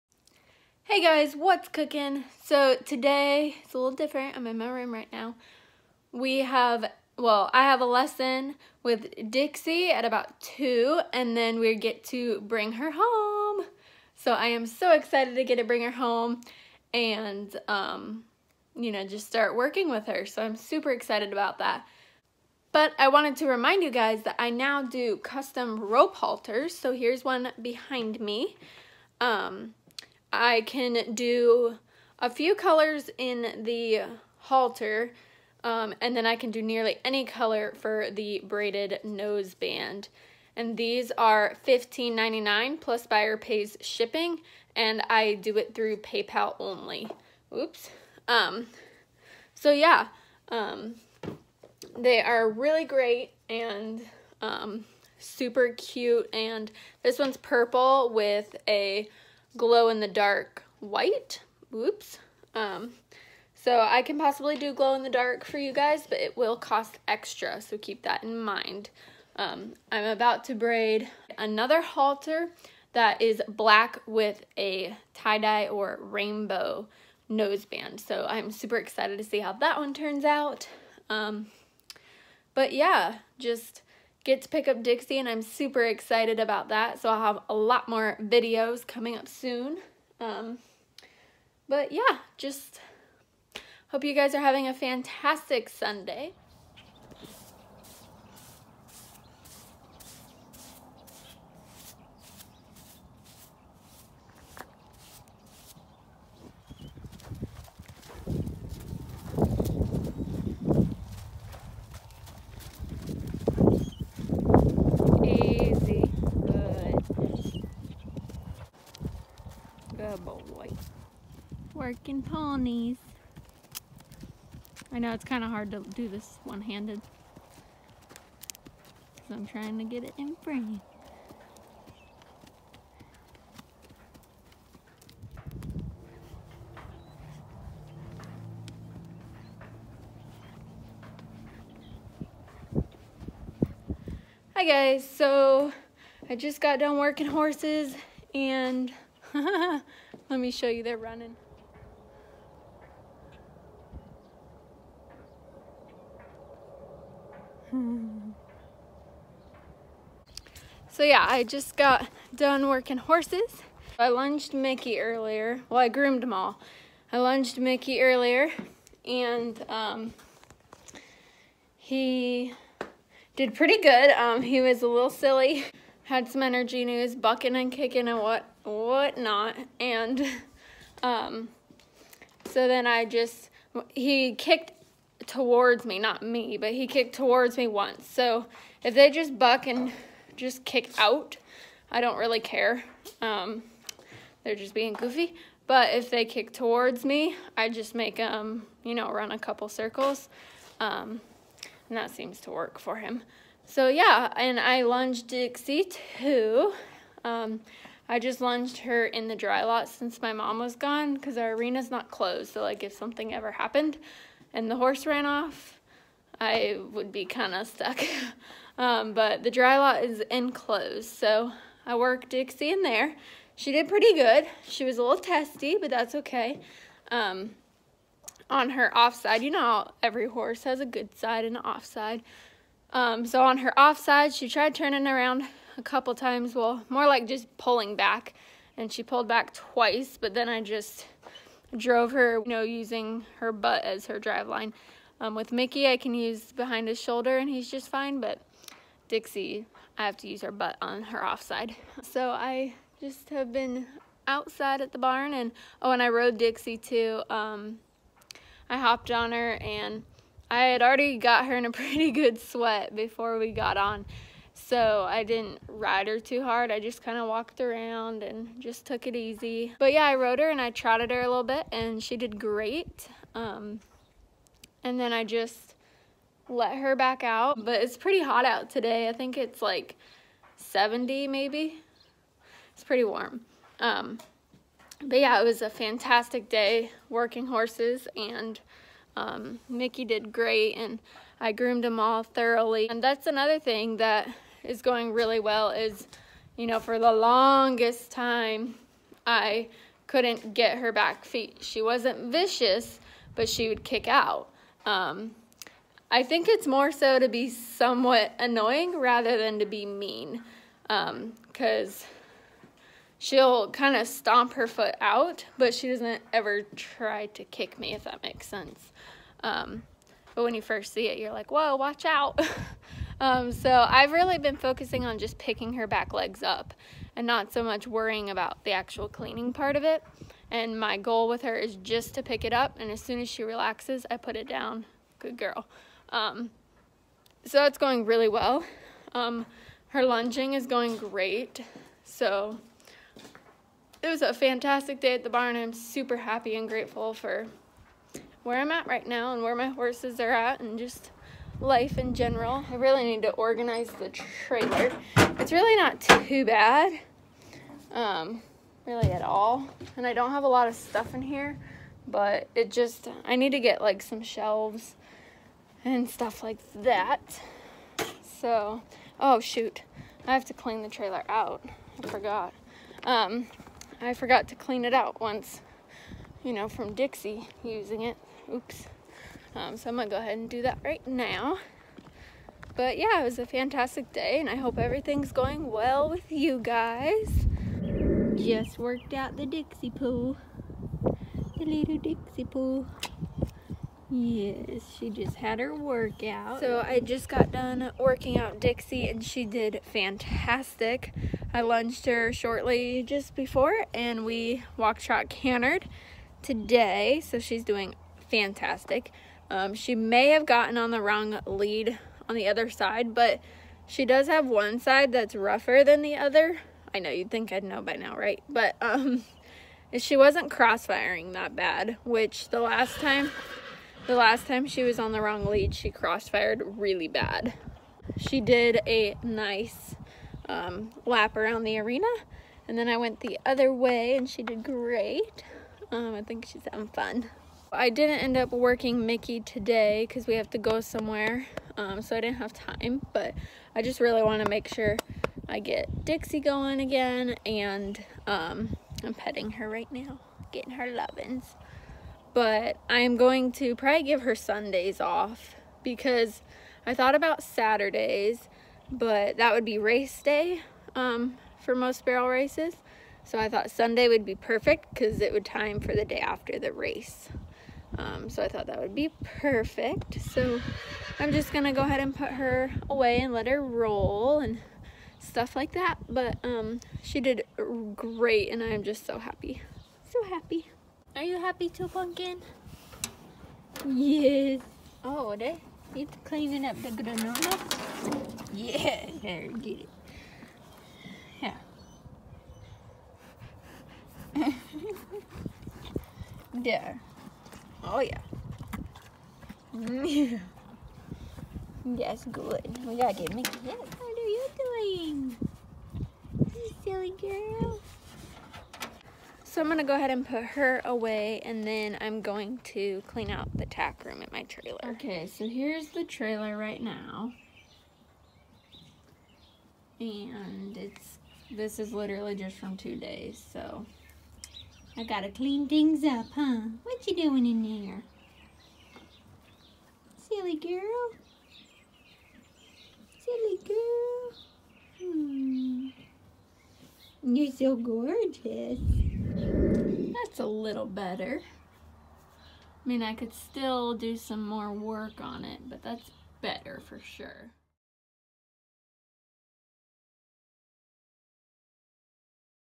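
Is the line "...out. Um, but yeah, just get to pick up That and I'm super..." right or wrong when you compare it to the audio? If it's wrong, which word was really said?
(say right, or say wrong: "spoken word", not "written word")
wrong: "Dixie", not "That".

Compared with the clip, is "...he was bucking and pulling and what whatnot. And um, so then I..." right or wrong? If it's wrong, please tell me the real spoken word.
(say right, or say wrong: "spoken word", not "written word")
wrong: "kicking", not "pulling".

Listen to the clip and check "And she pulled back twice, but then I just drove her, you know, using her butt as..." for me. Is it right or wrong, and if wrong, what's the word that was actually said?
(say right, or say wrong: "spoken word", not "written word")
right.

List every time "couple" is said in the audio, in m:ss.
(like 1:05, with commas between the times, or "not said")
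3:19, 3:55.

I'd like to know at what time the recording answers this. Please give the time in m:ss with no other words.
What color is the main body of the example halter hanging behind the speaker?
0:57.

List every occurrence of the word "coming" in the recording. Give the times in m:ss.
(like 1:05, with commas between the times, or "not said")
1:28.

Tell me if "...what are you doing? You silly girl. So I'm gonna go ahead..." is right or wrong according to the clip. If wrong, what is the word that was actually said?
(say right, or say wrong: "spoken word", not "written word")
right.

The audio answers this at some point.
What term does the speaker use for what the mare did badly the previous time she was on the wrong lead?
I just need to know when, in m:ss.
7:05.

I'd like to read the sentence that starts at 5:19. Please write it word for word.
Um, but when you first see it, you're like, whoa, watch out.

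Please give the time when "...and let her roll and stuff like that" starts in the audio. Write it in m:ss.
7:53.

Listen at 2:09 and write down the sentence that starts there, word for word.
Because I'm trying to get it in frame.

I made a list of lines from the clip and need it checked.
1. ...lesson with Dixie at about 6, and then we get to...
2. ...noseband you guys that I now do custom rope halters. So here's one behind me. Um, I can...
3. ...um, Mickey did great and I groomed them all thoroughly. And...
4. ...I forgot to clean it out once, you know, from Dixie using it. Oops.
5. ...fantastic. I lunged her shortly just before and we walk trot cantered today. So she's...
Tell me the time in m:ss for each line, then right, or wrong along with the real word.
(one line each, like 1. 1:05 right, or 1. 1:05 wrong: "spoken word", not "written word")
1. 0:07 wrong: "2", not "6"
2. 0:23 wrong: "remind", not "noseband"
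3. 4:49 right
4. 6:14 right
5. 6:39 right.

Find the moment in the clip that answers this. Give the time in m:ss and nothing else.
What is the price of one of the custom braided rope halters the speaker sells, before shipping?
0:41.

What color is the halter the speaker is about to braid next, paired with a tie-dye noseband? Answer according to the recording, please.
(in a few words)
Black.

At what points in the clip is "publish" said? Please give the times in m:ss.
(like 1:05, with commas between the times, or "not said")
not said.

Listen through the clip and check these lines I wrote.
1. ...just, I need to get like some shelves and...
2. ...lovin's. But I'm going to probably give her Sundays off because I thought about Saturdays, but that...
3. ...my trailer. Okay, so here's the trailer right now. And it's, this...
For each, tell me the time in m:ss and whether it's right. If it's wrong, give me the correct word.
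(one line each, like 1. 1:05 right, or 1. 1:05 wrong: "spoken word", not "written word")
1. 6:02 right
2. 7:30 right
3. 8:34 right.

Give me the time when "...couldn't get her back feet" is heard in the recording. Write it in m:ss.
5:00.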